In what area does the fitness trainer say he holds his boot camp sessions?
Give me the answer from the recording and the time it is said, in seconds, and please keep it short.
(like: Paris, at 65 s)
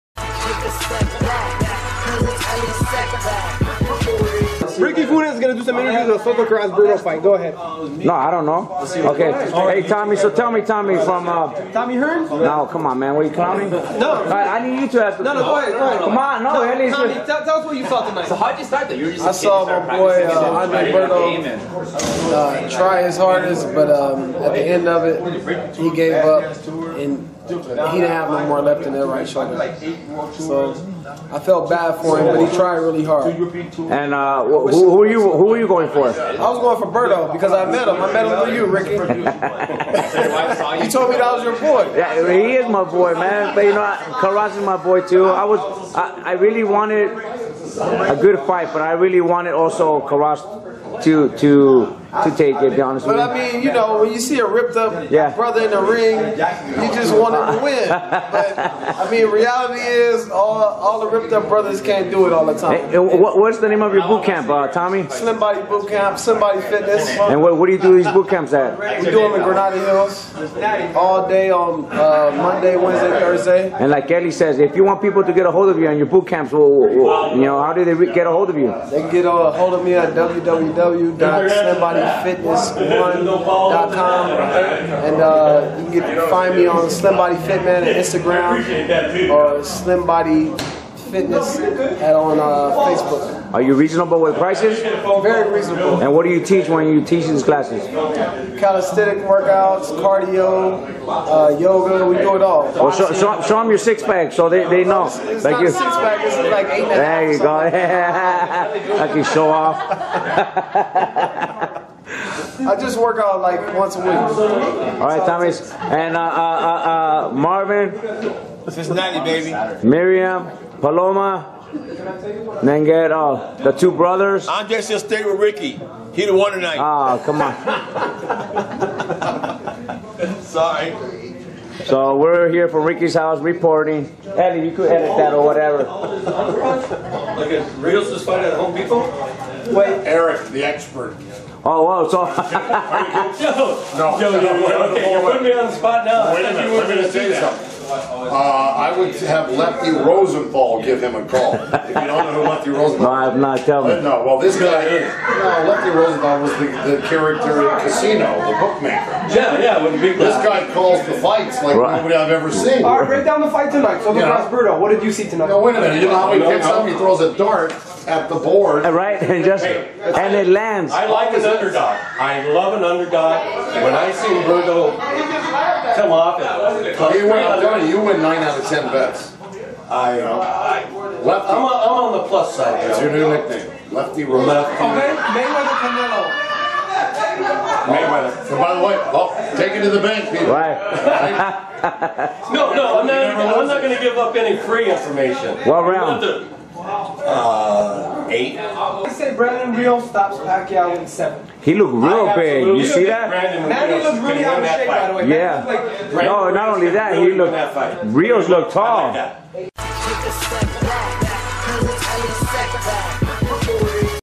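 Granada Hills, at 69 s.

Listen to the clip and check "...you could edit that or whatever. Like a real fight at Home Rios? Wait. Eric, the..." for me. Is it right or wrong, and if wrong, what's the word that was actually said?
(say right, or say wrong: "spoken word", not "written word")
wrong: "Depot", not "Rios".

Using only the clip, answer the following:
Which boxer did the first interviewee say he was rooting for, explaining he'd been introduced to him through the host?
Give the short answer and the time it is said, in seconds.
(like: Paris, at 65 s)
Andre Berto, at 20 s.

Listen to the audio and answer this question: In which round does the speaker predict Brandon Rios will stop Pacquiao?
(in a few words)
7.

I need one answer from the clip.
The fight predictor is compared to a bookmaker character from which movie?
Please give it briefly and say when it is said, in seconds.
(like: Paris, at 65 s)
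Casino, at 157 s.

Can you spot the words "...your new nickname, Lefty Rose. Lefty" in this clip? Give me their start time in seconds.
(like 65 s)
183 s.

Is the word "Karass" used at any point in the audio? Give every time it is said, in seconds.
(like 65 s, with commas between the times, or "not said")
6 s, 44 s, 50 s.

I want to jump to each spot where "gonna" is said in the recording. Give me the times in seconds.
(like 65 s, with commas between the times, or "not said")
5 s, 124 s.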